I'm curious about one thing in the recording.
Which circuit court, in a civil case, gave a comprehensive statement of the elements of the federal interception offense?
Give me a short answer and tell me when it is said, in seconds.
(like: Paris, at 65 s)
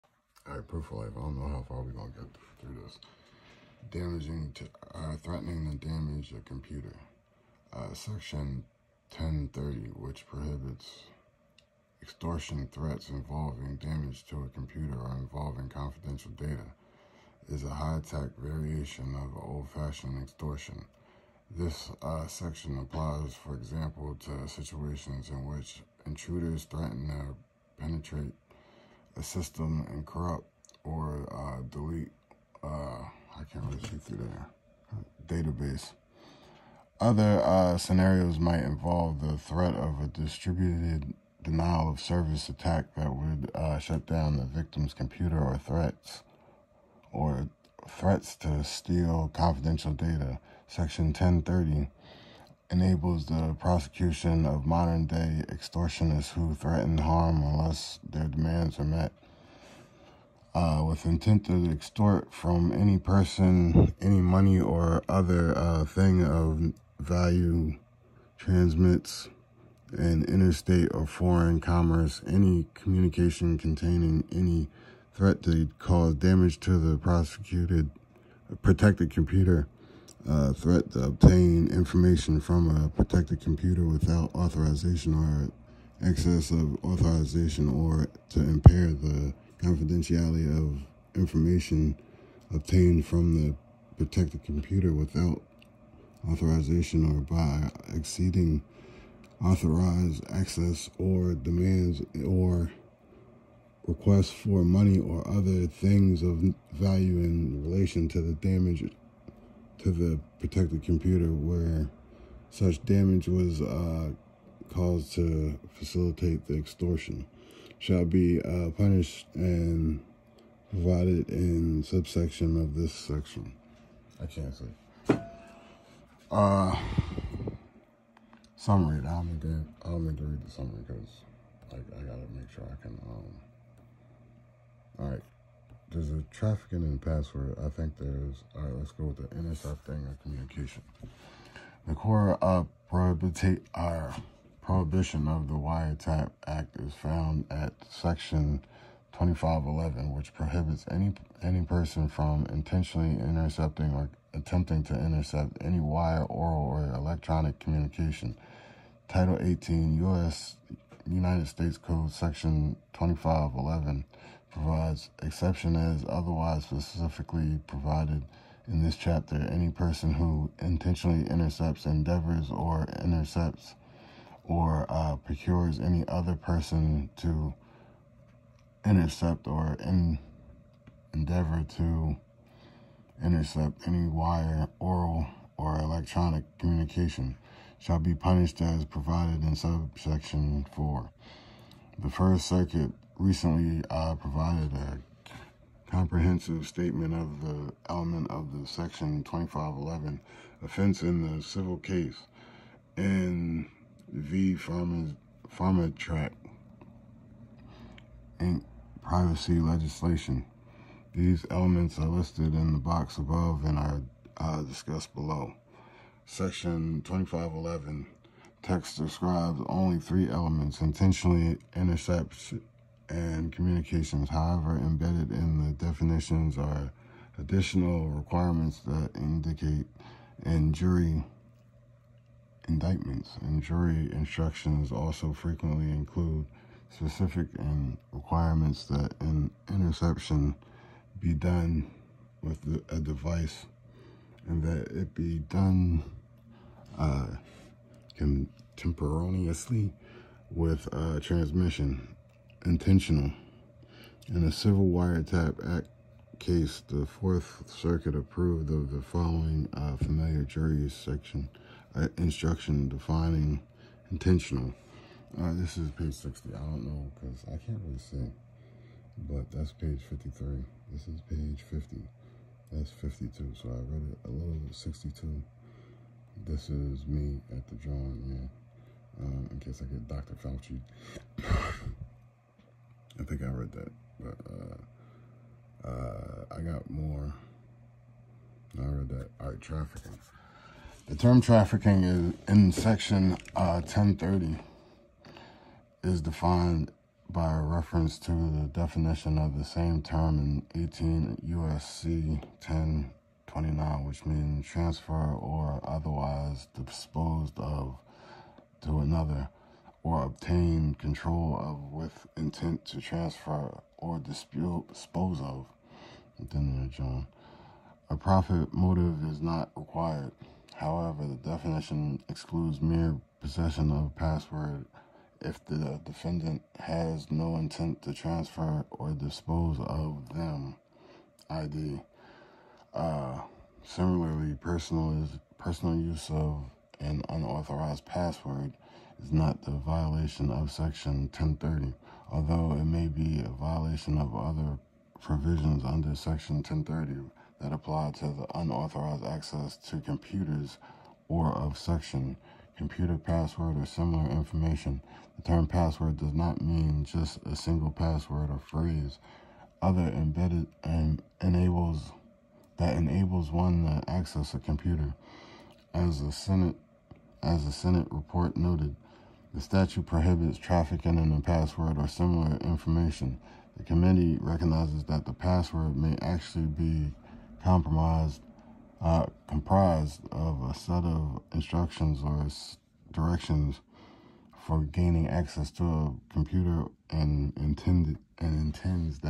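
First Circuit, at 191 s.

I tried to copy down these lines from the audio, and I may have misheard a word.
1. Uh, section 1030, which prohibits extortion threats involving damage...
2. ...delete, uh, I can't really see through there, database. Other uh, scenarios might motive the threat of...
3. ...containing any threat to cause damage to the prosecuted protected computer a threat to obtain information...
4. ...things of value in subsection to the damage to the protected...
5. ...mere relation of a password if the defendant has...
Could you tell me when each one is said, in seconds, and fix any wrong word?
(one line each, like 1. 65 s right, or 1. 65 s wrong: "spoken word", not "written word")
1. 7 s right
2. 31 s wrong: "involve", not "motive"
3. 73 s right
4. 105 s wrong: "relation", not "subsection"
5. 322 s wrong: "possession", not "relation".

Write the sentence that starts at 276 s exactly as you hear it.
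This is me at the drawing, yeah.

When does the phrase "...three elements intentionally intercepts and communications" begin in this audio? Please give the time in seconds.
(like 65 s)
219 s.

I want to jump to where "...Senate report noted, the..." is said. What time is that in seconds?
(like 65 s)
367 s.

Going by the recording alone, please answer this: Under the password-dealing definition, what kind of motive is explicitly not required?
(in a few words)
A profit motive.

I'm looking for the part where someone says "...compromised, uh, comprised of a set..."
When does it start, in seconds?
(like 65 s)
377 s.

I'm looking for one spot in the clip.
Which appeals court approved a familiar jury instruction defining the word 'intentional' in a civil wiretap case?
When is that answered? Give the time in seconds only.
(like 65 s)
256 s.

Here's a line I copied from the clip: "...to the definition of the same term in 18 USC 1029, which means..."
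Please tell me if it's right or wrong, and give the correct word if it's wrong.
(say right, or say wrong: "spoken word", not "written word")
right.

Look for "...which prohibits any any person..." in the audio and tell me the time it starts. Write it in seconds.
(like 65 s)
150 s.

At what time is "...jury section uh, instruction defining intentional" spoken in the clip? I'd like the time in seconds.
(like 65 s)
260 s.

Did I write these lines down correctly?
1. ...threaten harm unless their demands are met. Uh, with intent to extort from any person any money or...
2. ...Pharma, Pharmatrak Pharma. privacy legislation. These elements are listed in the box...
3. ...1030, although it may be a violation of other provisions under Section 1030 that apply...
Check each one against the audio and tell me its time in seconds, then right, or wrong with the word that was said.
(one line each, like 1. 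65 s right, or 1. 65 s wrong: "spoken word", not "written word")
1. 56 s right
2. 204 s wrong: "Inc", not "Pharma"
3. 341 s right.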